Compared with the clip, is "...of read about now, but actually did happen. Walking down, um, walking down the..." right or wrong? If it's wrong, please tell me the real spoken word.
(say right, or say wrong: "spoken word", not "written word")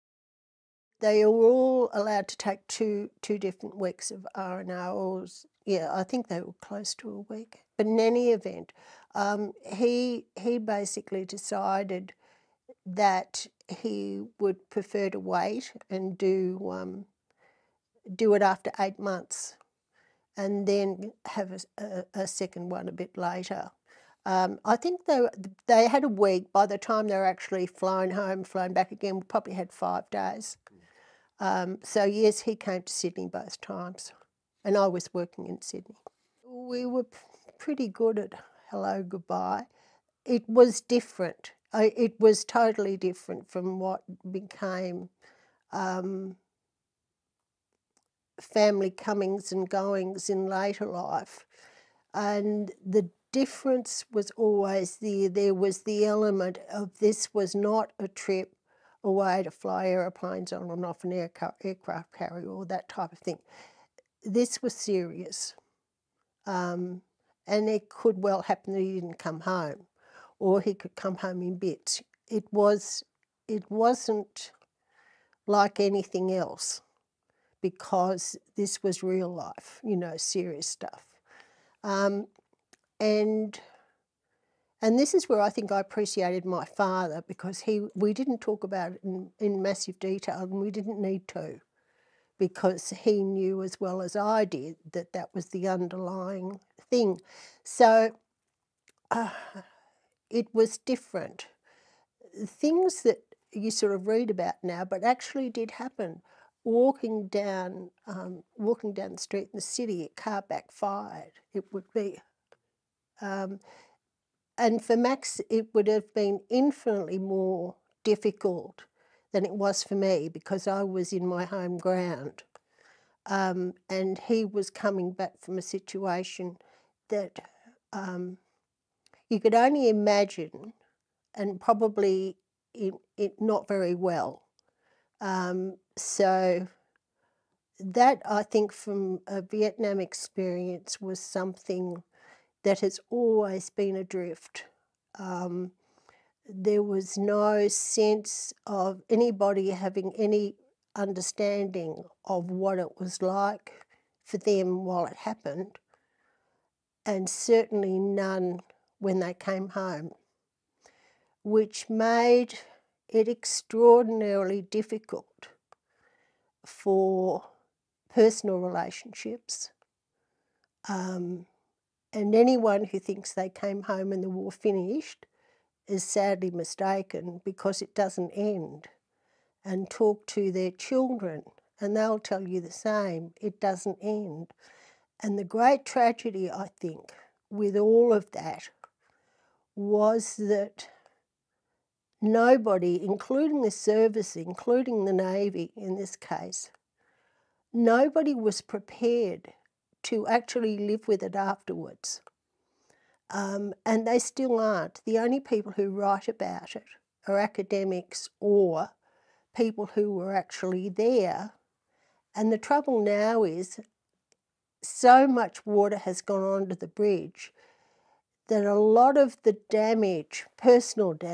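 right.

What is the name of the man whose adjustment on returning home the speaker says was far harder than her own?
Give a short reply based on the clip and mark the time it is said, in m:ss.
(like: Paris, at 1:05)
Max, at 1:54.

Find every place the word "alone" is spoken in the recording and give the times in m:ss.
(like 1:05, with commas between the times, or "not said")
not said.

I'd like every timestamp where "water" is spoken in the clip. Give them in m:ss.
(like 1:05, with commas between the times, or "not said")
3:35.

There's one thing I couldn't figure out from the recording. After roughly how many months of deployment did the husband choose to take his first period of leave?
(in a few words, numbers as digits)
8 months.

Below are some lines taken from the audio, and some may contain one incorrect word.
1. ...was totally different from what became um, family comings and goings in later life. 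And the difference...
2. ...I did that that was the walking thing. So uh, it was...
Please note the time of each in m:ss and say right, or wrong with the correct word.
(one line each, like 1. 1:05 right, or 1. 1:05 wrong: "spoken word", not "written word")
1. 0:42 right
2. 1:34 wrong: "underlying", not "walking".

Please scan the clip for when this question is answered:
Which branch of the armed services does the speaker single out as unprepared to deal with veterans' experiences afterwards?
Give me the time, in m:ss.
3:15.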